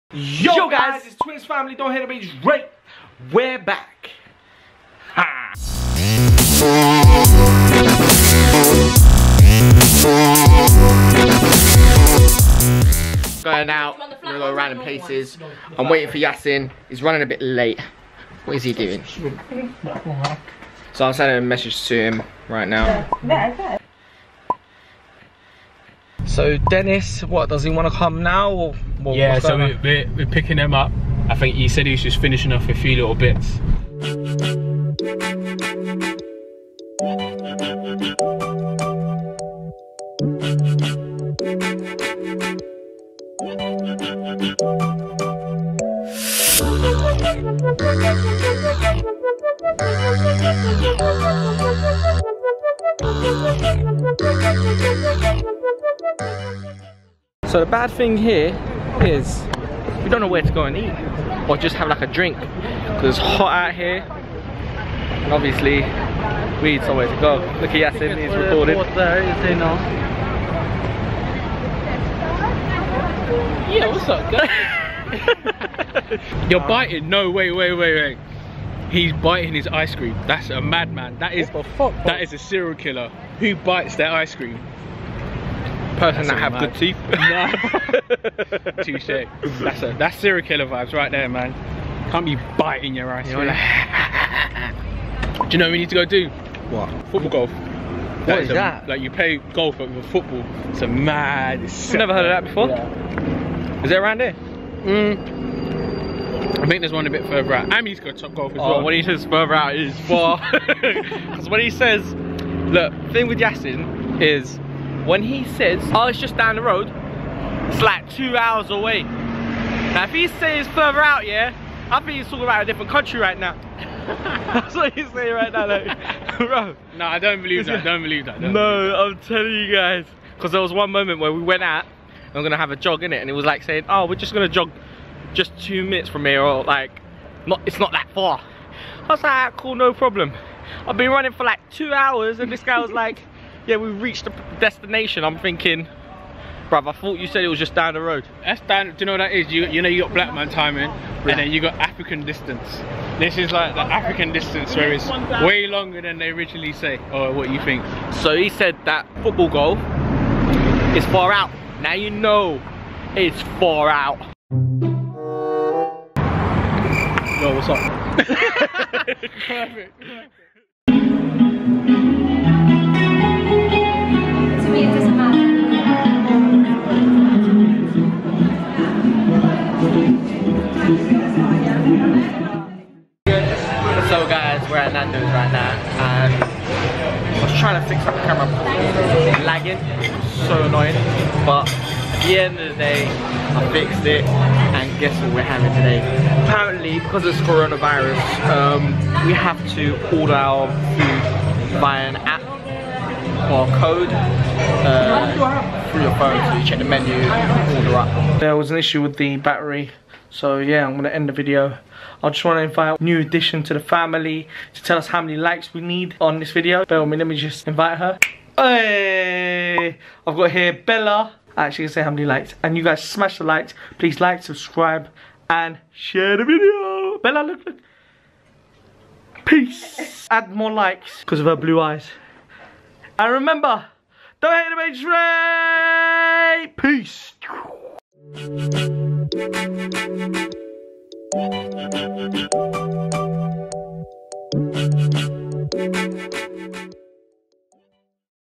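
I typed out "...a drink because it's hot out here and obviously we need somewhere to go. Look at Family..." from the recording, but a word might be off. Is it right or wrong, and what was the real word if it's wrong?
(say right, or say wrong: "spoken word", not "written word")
wrong: "Yasin", not "Family".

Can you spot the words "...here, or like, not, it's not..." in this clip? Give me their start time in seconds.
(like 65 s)
136 s.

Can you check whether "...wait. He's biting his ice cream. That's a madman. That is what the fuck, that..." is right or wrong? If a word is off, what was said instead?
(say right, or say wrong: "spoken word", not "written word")
right.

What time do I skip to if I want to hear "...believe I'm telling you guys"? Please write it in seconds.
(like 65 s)
128 s.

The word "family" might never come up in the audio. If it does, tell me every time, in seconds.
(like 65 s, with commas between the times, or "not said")
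1 s, 213 s.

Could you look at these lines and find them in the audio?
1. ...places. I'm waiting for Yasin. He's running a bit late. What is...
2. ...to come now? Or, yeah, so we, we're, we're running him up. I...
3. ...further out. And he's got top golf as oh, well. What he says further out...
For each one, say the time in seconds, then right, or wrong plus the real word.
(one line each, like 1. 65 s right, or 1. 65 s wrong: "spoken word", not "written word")
1. 14 s right
2. 27 s wrong: "picking", not "running"
3. 107 s right.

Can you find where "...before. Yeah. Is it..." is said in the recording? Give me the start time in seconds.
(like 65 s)
102 s.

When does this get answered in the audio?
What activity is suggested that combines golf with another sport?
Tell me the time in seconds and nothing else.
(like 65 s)
97 s.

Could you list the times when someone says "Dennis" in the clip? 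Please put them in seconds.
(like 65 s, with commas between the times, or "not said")
26 s.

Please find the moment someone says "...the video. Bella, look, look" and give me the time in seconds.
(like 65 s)
226 s.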